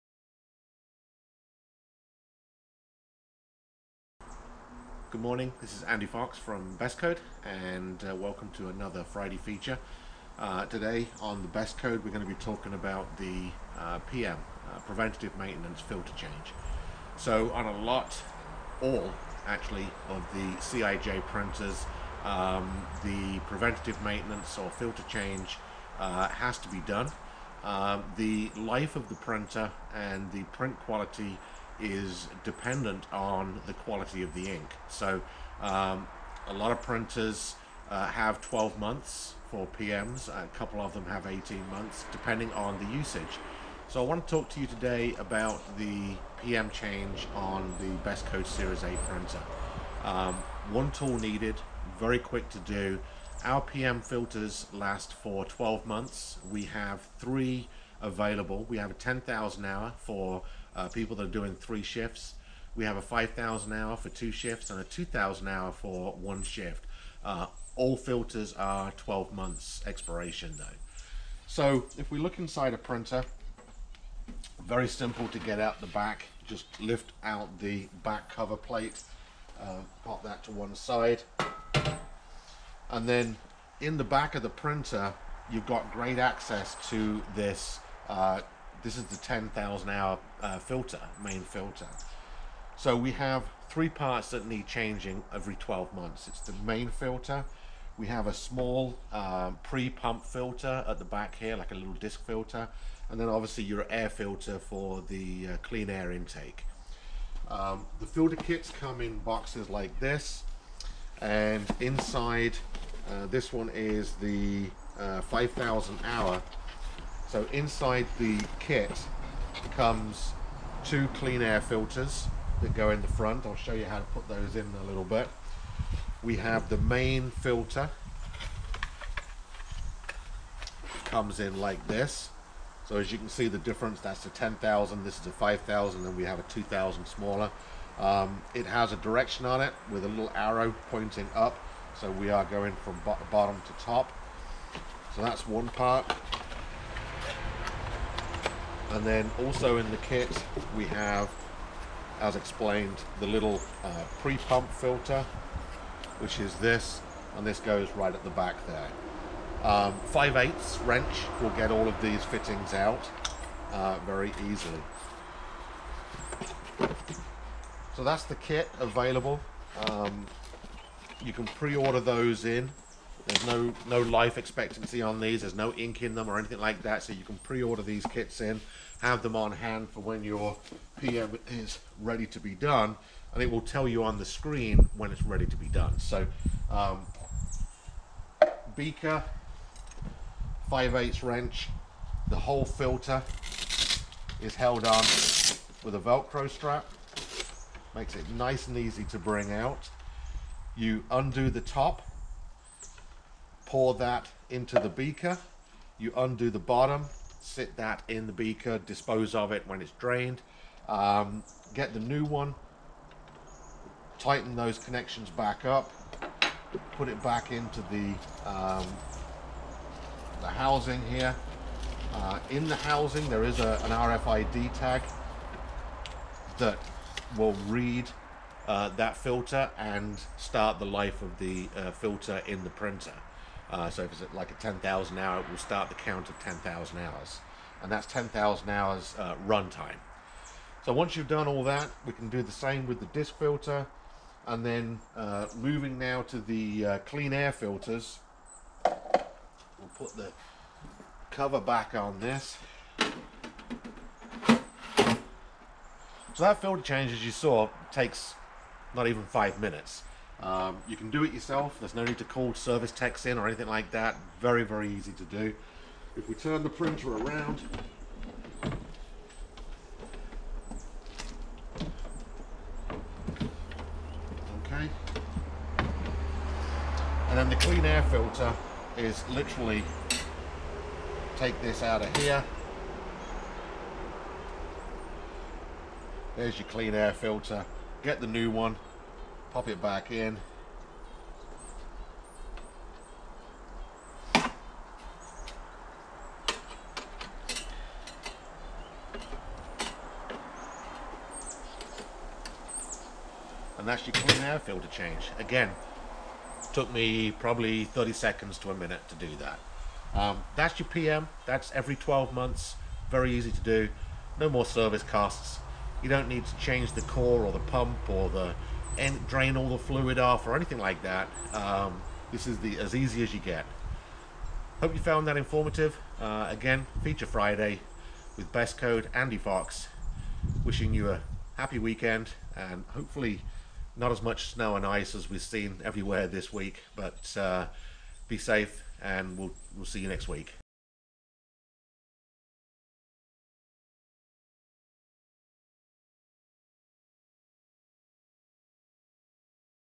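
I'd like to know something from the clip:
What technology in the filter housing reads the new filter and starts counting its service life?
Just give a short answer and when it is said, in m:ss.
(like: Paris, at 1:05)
RFID tag, at 3:43.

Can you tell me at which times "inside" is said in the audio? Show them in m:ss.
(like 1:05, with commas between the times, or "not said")
1:12, 1:51, 1:57.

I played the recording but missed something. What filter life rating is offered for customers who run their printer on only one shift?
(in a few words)
2,000 hour.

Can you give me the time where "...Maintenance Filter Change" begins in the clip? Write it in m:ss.
0:15.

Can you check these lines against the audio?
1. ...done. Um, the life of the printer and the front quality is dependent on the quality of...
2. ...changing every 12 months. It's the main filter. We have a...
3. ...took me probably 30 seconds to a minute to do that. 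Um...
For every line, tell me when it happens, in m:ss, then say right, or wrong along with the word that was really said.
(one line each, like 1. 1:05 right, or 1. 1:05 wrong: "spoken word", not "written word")
1. 0:26 wrong: "print", not "front"
2. 1:34 right
3. 5:06 right.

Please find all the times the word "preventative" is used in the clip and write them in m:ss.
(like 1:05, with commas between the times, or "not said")
0:14, 0:23.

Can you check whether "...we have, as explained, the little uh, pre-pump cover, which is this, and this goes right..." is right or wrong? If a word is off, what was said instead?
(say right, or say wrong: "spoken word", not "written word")
wrong: "filter", not "cover".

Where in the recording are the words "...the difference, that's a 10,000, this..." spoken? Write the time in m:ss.
2:13.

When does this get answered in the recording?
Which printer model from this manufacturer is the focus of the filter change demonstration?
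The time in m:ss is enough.
0:48.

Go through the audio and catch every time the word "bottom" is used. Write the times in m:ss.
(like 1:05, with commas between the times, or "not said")
2:23, 3:26.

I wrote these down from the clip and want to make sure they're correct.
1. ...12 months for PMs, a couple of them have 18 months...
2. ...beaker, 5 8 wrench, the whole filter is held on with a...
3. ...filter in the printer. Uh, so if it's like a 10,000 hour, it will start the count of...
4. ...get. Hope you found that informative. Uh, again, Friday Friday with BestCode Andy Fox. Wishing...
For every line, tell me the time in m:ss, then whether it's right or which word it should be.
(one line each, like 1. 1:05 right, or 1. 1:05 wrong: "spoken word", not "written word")
1. 0:38 right
2. 3:08 right
3. 3:51 right
4. 5:23 wrong: "Feature", not "Friday".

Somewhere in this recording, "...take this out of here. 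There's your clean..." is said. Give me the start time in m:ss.
4:41.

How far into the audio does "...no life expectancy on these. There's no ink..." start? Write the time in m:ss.
2:53.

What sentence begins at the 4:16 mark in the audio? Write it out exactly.
So that filter change, as you saw, takes not even five minutes.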